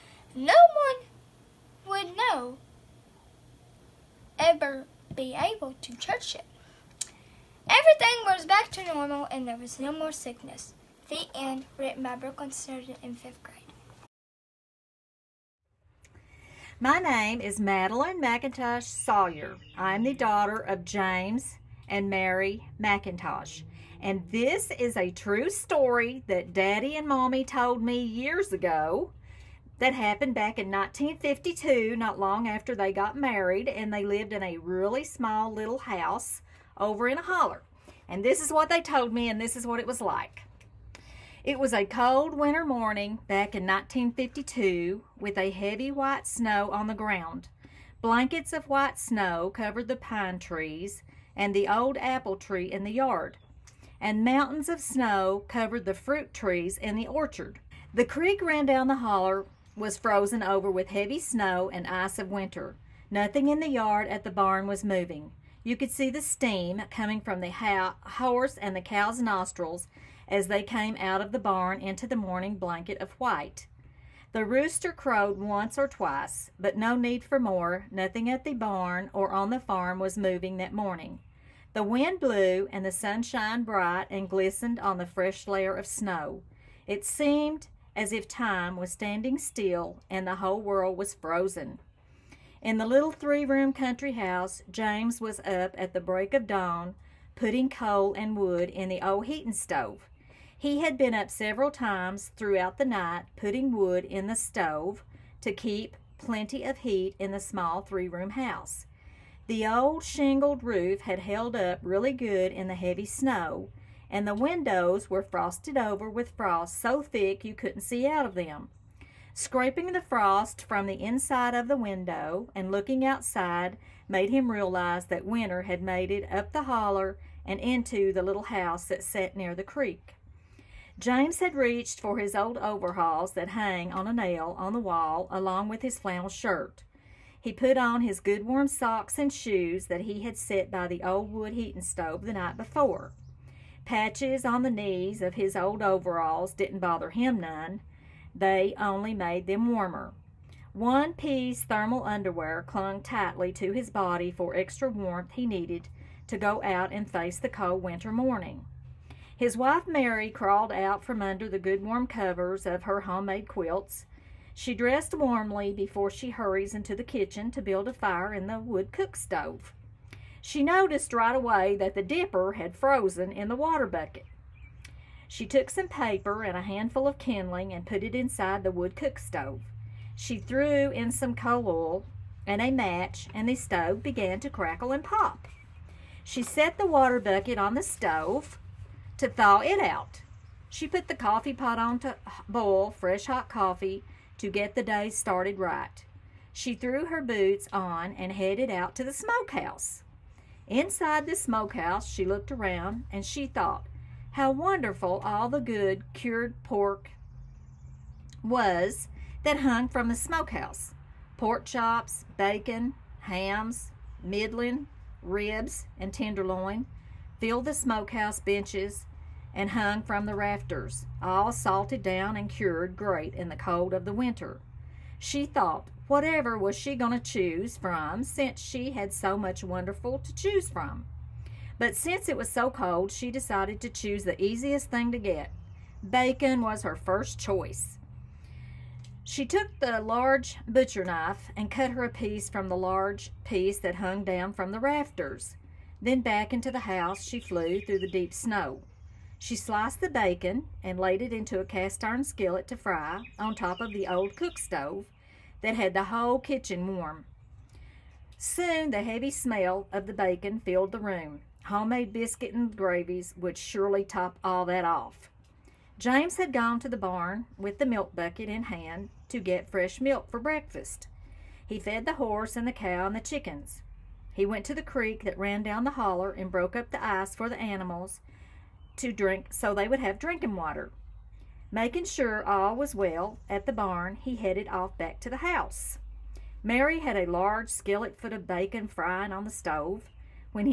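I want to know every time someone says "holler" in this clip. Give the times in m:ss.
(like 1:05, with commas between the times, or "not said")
0:37, 0:58, 2:06, 4:35.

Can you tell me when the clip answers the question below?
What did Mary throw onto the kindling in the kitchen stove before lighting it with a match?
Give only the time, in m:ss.
3:01.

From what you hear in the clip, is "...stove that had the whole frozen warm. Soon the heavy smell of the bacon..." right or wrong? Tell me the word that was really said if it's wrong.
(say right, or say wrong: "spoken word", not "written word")
wrong: "kitchen", not "frozen".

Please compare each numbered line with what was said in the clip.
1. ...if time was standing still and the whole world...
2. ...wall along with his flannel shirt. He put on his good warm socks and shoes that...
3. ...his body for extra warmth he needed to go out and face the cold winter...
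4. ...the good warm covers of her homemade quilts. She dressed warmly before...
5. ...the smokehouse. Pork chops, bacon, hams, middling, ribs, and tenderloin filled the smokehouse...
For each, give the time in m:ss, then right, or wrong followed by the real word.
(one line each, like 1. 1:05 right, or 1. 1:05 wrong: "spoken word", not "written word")
1. 1:28 right
2. 2:14 right
3. 2:33 right
4. 2:41 right
5. 3:30 right.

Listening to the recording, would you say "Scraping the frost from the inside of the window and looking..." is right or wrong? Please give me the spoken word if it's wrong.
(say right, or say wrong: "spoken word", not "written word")
right.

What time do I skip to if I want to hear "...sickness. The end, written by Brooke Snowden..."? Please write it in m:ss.
0:10.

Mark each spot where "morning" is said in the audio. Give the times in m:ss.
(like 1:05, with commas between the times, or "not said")
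0:42, 1:12, 1:20, 2:38.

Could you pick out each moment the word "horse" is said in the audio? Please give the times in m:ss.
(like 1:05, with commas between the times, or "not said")
1:07, 4:32.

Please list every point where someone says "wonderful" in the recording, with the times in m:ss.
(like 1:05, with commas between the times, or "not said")
3:24, 3:49.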